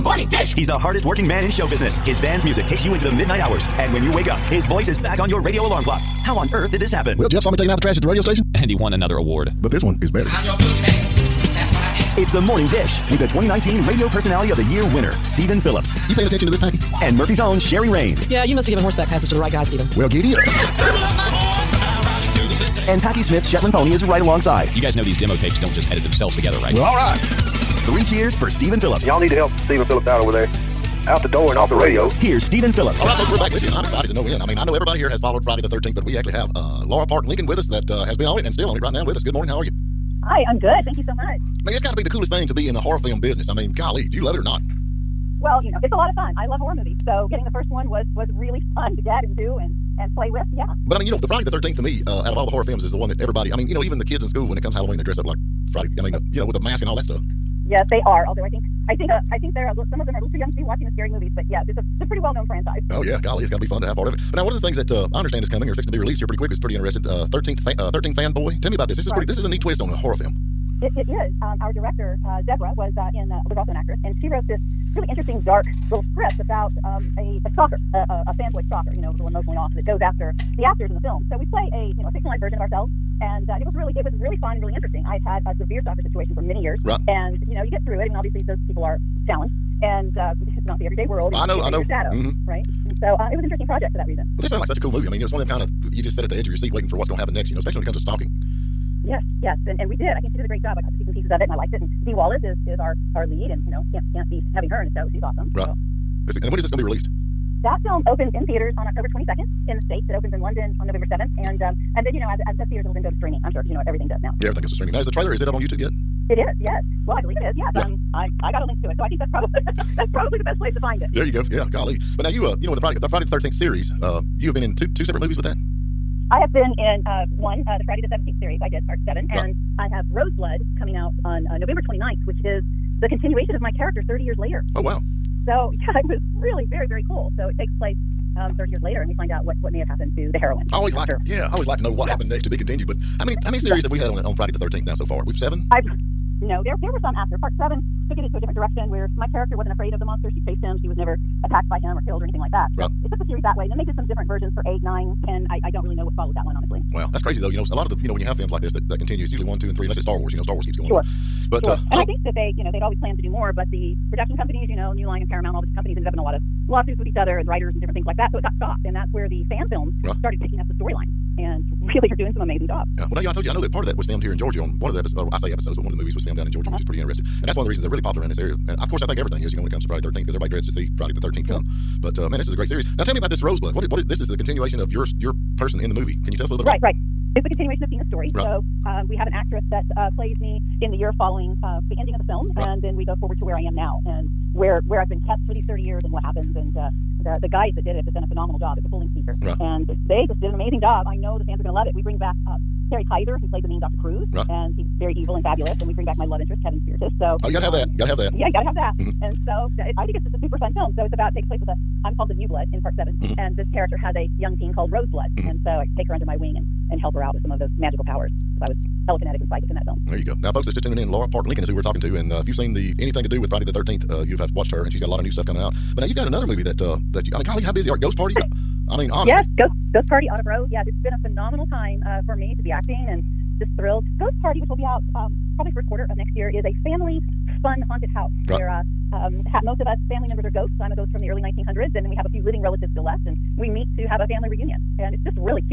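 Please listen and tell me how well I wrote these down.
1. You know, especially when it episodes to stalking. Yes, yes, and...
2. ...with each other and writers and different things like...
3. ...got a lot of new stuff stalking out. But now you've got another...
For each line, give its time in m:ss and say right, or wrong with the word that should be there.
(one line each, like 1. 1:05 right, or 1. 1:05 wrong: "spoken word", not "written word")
1. 1:37 wrong: "comes", not "episodes"
2. 2:46 right
3. 3:44 wrong: "coming", not "stalking".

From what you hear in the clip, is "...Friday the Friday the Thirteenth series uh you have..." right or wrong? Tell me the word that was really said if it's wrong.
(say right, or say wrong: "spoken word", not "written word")
right.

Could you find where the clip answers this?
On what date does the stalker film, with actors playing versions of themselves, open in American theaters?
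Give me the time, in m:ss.
1:48.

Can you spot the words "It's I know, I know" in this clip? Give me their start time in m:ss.
1:31.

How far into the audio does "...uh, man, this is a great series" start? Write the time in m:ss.
3:02.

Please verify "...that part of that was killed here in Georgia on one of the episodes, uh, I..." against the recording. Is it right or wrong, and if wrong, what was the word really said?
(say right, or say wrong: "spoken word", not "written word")
wrong: "filmed", not "killed".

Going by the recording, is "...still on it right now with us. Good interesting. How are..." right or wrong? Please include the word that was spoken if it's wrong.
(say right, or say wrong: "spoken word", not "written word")
wrong: "morning", not "interesting".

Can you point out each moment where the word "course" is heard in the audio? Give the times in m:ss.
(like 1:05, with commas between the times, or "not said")
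2:58.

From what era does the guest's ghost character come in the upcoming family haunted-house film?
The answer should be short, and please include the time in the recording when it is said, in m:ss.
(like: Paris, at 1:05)
Early 1900s, at 4:01.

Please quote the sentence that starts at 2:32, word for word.
Right it took the series that way.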